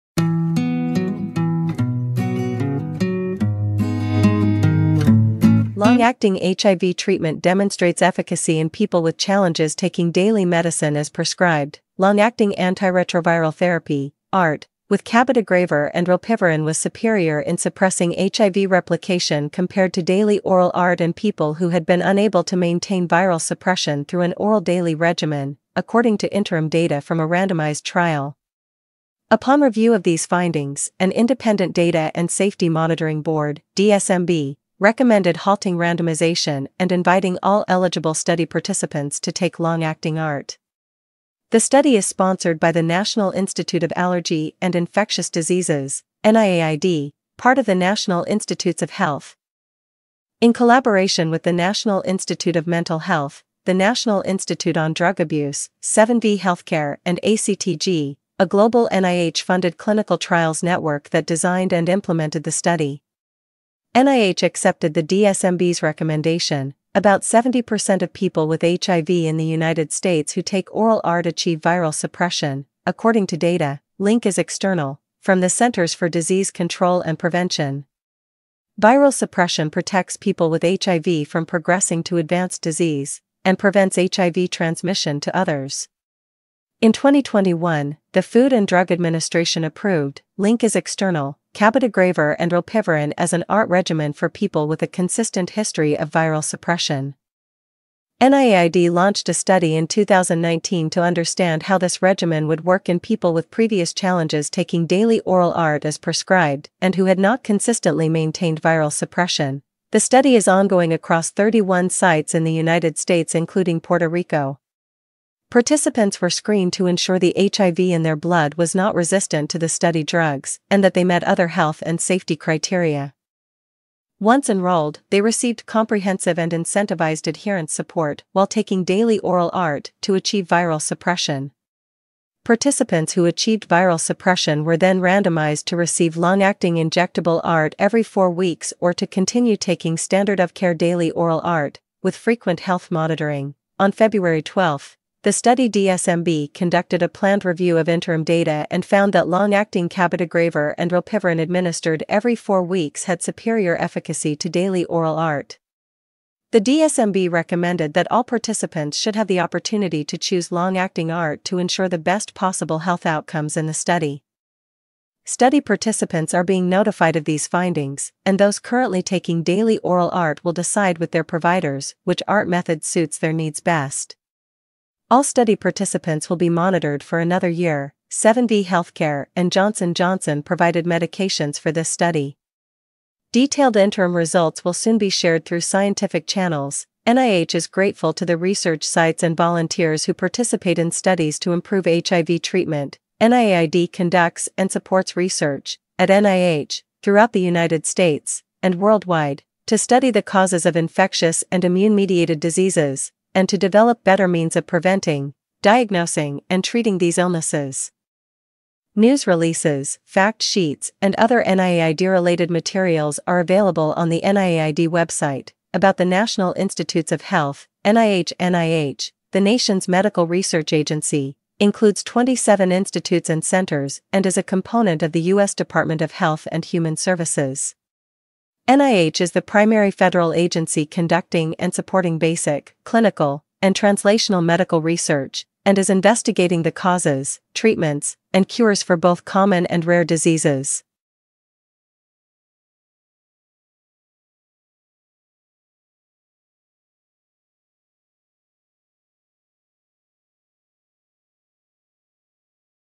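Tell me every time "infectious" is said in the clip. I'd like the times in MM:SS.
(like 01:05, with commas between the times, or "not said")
00:44, 03:20.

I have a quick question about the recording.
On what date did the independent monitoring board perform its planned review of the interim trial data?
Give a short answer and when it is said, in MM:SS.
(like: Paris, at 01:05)
February 12, at 02:23.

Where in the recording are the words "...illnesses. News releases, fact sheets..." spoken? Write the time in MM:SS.
03:27.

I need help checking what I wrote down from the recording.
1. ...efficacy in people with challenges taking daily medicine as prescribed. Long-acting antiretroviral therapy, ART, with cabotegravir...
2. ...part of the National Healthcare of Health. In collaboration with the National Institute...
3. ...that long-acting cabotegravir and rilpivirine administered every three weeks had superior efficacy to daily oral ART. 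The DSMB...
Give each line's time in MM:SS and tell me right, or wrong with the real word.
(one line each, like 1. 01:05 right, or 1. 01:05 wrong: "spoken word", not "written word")
1. 00:08 right
2. 00:47 wrong: "Institutes", not "Healthcare"
3. 02:29 wrong: "four", not "three".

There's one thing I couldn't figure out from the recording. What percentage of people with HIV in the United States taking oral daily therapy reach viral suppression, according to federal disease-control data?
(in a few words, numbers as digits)
70%.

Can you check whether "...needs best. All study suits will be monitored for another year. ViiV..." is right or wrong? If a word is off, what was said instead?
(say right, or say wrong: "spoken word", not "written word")
wrong: "participants", not "suits".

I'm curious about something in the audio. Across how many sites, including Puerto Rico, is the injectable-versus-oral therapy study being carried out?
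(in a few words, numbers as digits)
31.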